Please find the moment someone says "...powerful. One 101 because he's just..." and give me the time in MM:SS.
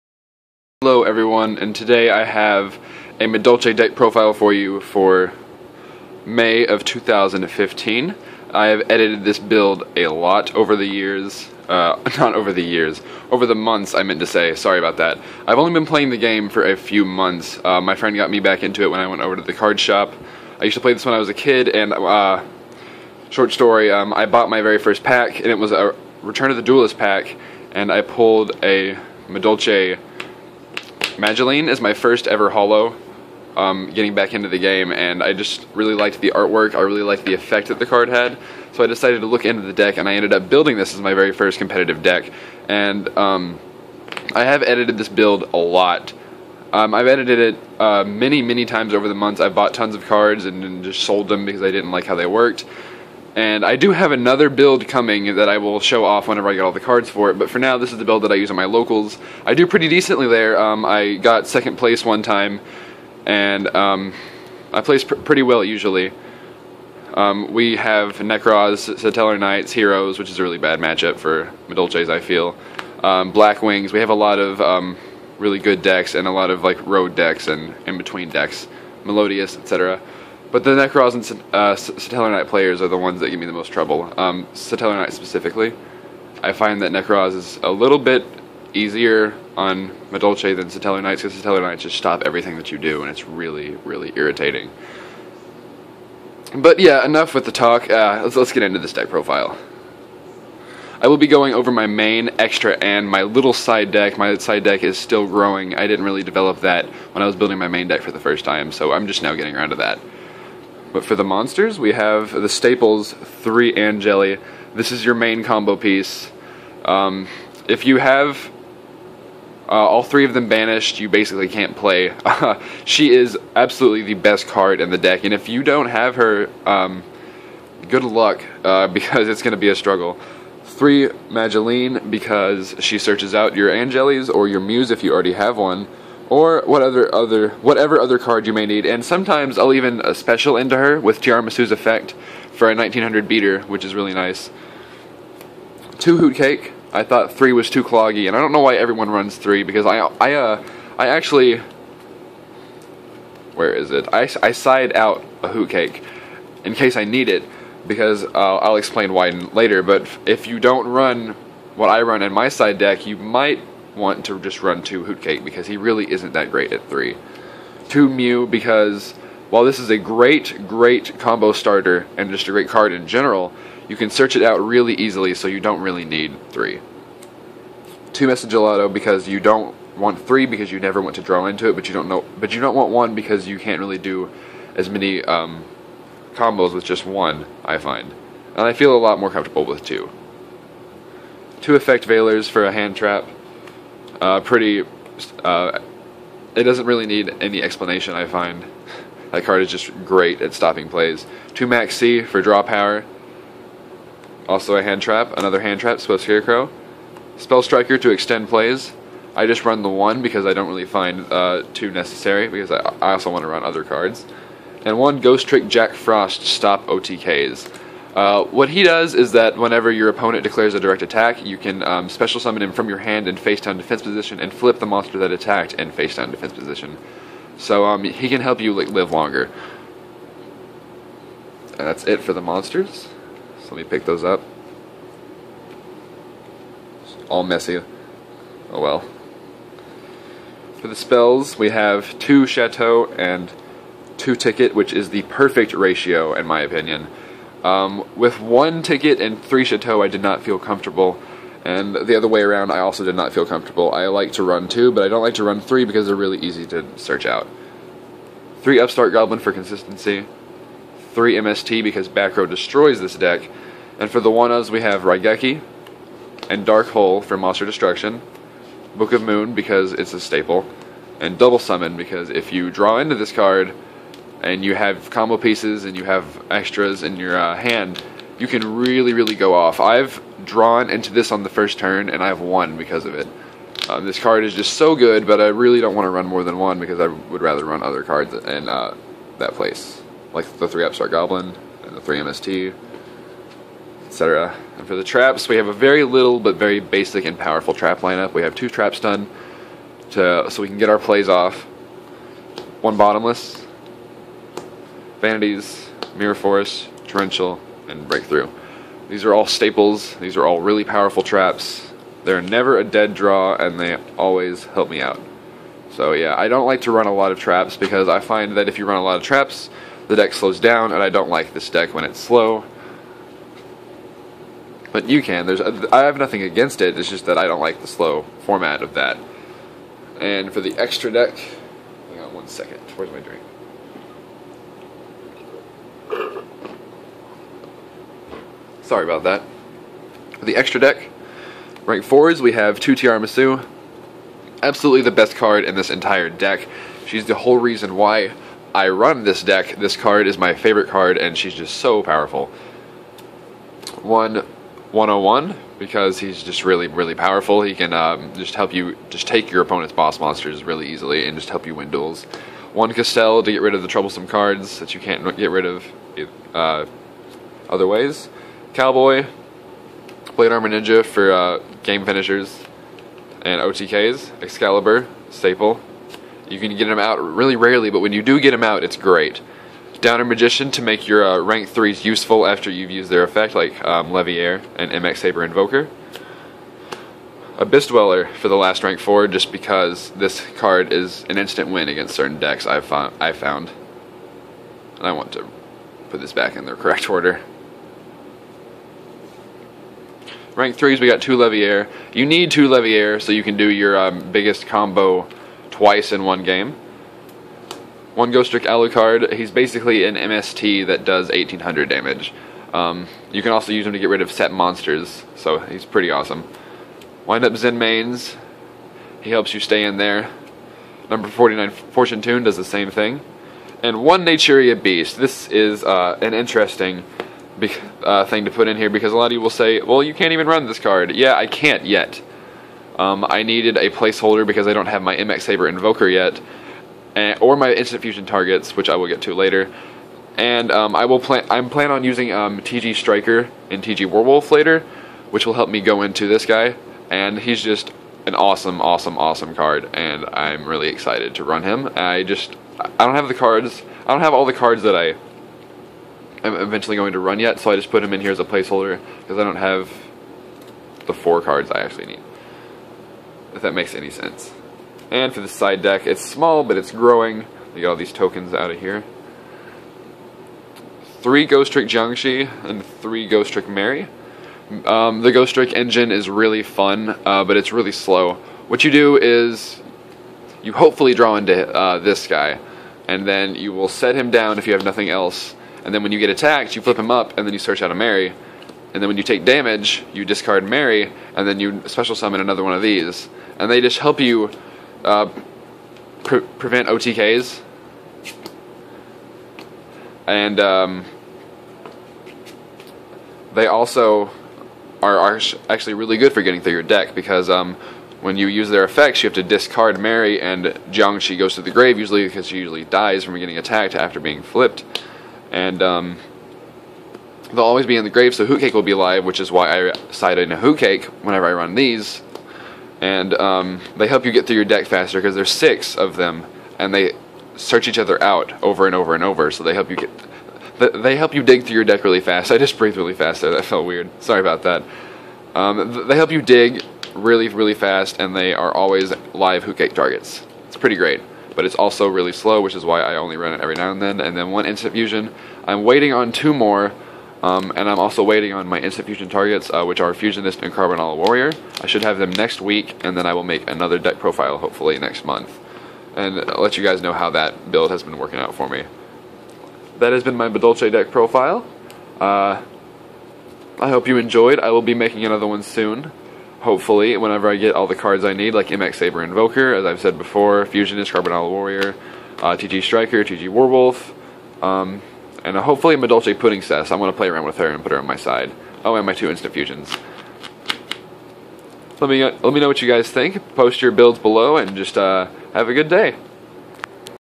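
05:52.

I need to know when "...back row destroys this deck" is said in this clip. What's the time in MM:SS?
04:22.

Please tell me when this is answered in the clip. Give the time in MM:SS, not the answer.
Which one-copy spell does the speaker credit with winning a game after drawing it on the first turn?
04:31.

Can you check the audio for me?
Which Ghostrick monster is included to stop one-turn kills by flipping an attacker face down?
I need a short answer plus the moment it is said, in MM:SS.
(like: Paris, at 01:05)
Ghostrick Jackfrost, at 03:35.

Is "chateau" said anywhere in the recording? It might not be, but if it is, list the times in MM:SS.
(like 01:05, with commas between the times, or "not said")
04:02, 04:09.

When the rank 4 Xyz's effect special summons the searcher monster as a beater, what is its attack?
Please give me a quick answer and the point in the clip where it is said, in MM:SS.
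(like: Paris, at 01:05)
1900, at 02:22.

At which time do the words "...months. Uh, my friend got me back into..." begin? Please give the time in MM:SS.
00:17.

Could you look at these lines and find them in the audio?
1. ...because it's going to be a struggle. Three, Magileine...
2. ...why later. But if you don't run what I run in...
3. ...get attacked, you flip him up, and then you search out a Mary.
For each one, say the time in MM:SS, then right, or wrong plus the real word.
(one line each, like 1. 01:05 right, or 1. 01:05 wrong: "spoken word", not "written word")
1. 02:08 right
2. 02:39 right
3. 08:06 right.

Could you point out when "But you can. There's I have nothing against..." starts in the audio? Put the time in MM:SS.
05:24.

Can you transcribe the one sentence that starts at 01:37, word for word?
Uh, let's, let's get into this deck profile.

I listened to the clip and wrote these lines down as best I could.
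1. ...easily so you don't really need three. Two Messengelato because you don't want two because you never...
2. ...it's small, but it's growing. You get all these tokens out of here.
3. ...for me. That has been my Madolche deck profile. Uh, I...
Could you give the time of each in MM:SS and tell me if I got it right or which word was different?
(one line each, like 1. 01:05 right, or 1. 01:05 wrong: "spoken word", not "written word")
1. 02:54 wrong: "three", not "two"
2. 07:46 right
3. 09:18 right.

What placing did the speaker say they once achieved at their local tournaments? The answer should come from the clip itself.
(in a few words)
Second place.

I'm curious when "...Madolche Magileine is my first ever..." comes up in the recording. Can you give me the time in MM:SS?
00:29.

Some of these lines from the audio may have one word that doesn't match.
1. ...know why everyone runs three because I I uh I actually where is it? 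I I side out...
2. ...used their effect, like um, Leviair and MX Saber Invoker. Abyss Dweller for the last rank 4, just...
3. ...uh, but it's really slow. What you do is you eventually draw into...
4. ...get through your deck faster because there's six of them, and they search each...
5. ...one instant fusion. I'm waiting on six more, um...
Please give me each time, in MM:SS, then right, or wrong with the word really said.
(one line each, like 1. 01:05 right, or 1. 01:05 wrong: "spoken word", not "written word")
1. 02:28 right
2. 06:22 right
3. 07:57 wrong: "hopefully", not "eventually"
4. 08:44 right
5. 09:04 wrong: "two", not "six".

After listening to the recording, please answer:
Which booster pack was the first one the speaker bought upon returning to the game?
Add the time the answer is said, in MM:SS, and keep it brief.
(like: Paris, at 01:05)
Return of the Duelist, at 00:26.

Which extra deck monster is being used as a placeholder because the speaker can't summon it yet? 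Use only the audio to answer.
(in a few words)
Naturia Beast.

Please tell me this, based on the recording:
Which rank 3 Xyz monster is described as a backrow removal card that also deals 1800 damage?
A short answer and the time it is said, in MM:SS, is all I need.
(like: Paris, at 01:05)
Ghostrick Alucard, at 06:48.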